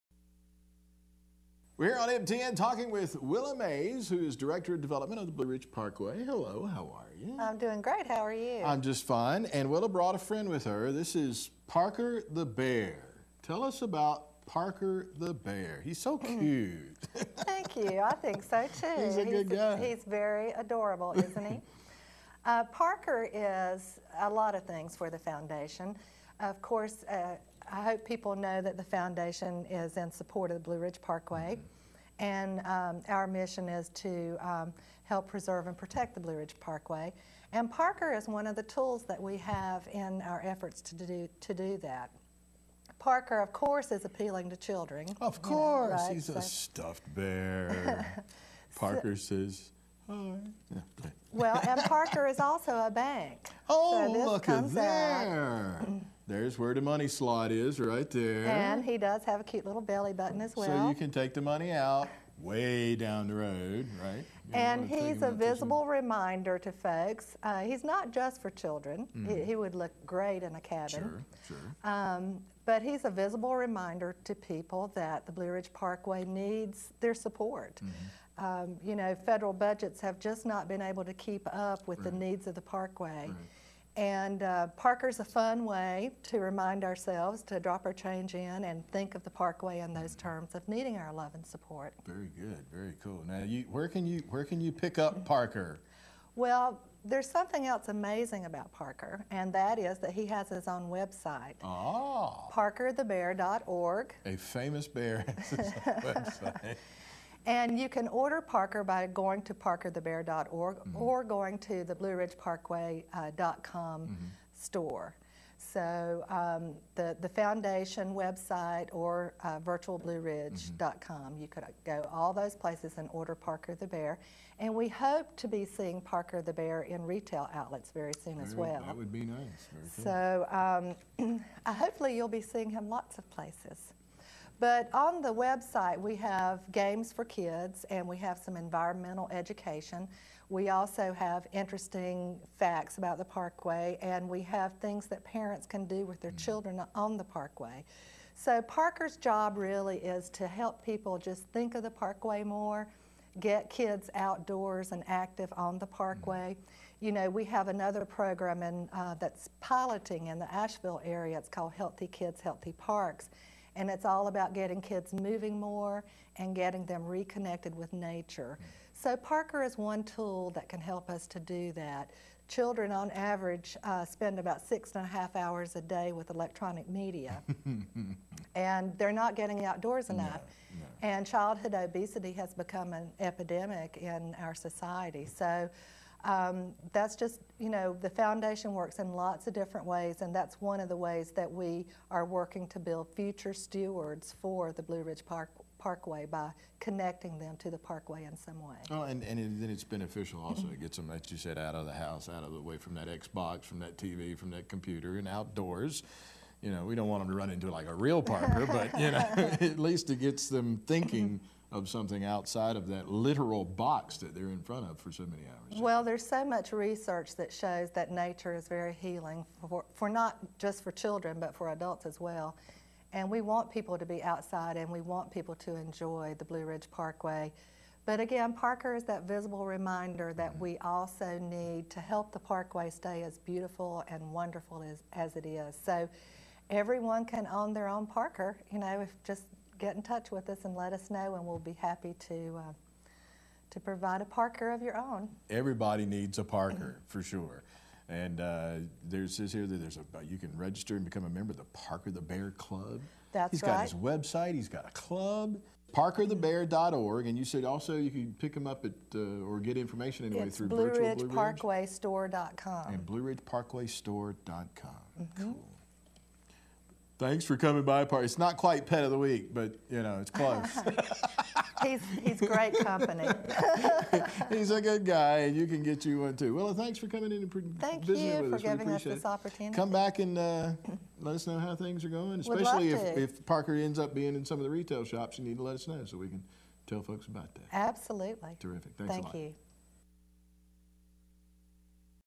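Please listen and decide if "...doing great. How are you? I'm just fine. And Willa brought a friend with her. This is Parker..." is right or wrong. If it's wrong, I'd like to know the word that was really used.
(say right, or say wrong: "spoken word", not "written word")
right.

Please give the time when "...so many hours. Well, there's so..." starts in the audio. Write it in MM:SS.
03:35.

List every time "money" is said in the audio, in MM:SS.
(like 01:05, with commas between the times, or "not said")
00:56, 01:01.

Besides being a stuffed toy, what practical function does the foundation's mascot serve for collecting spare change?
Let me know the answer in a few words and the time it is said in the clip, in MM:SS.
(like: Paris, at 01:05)
A bank, at 00:52.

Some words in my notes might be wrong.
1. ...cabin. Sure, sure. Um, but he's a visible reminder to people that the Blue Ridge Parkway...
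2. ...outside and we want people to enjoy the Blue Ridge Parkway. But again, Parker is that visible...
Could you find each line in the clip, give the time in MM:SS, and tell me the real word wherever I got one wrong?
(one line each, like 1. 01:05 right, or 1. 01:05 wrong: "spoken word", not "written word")
1. 01:10 right
2. 03:44 right.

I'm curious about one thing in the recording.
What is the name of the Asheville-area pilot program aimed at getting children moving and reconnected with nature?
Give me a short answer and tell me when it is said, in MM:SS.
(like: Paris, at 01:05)
Healthy Kids, Healthy Parks, at 02:41.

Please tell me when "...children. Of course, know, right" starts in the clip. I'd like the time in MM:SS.
00:44.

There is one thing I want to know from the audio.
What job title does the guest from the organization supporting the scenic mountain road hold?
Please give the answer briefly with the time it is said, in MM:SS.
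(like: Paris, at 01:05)
Director of Development, at 00:04.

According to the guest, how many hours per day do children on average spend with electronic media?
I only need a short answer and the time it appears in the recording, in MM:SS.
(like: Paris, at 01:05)
6.5 hours, at 02:54.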